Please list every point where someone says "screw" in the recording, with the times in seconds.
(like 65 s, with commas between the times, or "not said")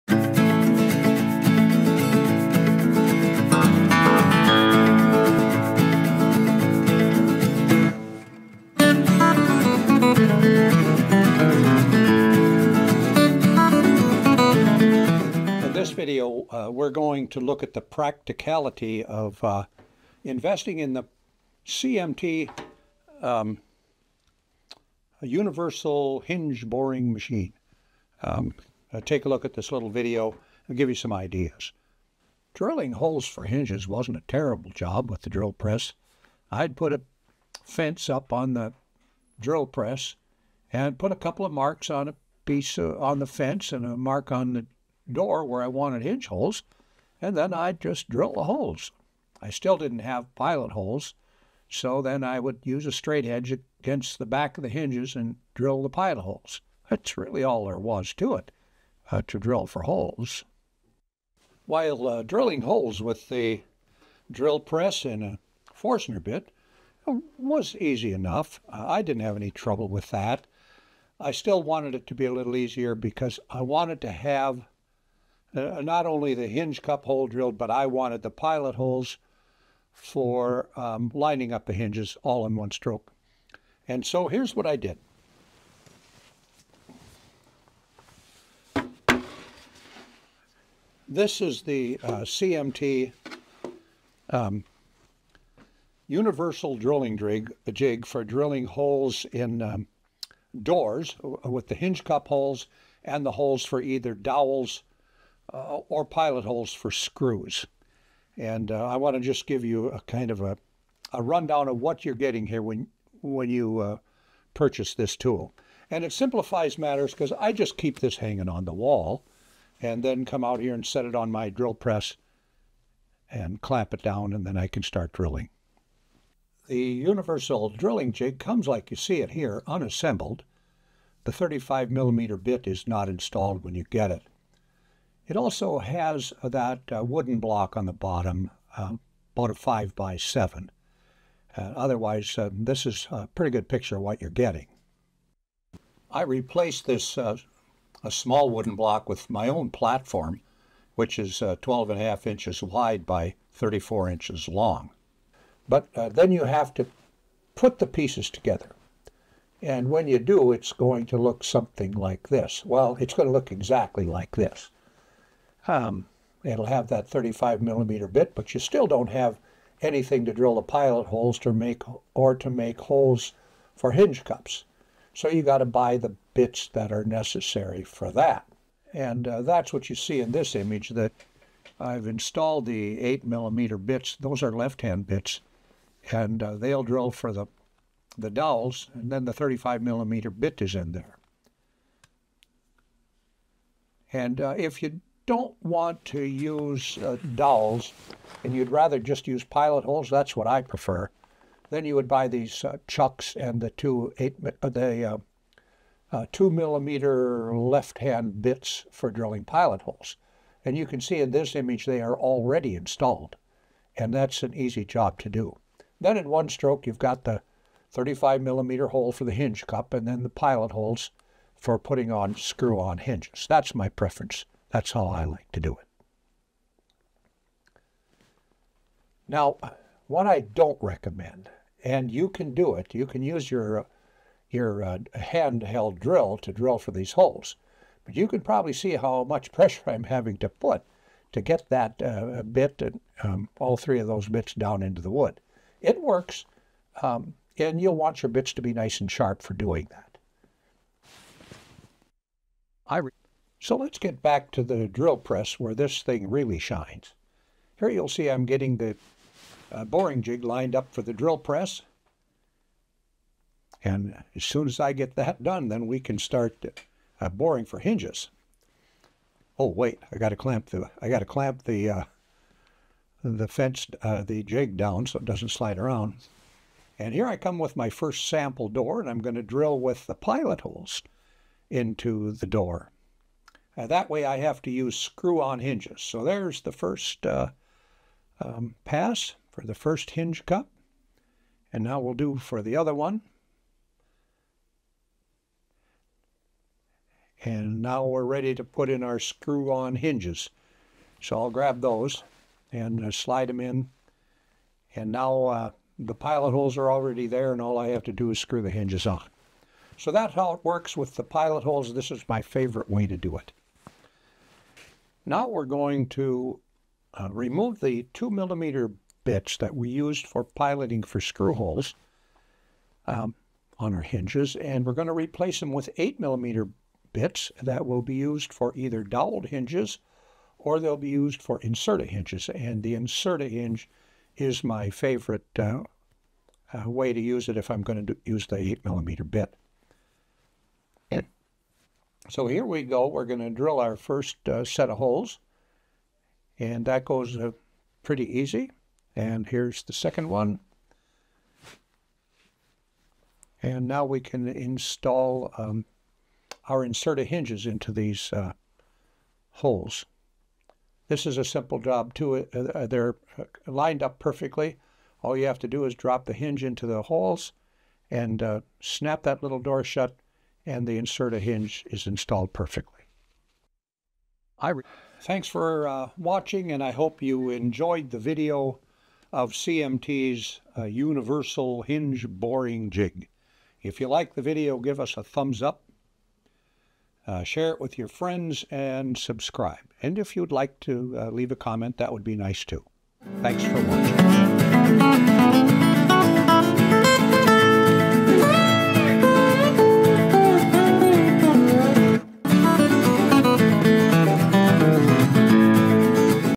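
106 s, 222 s, 284 s, 299 s, 308 s, 321 s.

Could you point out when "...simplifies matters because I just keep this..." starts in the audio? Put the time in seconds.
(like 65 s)
116 s.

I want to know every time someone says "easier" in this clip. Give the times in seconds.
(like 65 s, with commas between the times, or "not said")
72 s.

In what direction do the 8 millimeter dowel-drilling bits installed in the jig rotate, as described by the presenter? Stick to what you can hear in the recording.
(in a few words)
Left-hand.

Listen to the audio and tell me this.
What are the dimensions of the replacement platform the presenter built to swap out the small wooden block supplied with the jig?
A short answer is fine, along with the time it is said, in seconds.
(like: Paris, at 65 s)
12.5 by 34 inches, at 151 s.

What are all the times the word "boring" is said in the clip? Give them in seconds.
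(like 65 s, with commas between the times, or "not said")
26 s, 259 s, 267 s, 382 s.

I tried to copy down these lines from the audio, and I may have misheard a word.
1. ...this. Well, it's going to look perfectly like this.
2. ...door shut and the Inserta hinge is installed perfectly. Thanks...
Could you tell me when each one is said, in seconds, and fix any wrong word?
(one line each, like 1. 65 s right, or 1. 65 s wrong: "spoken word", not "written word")
1. 162 s wrong: "exactly", not "perfectly"
2. 369 s right.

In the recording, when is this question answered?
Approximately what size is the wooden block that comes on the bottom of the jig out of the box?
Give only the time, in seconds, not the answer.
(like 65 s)
139 s.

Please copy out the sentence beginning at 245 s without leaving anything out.
It works, um, and you'll want your bits to be nice and sharp for doing that.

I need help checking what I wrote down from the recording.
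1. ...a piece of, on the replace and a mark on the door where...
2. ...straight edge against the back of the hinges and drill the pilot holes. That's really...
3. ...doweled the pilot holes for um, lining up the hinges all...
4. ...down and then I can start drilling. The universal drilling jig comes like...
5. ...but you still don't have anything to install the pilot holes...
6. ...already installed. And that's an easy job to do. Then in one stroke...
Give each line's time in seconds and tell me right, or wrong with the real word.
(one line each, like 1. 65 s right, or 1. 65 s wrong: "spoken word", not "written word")
1. 42 s wrong: "fence", not "replace"
2. 52 s right
3. 77 s wrong: "wanted", not "doweled"
4. 124 s right
5. 168 s wrong: "drill", not "install"
6. 212 s right.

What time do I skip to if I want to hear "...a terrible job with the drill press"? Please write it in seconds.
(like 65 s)
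34 s.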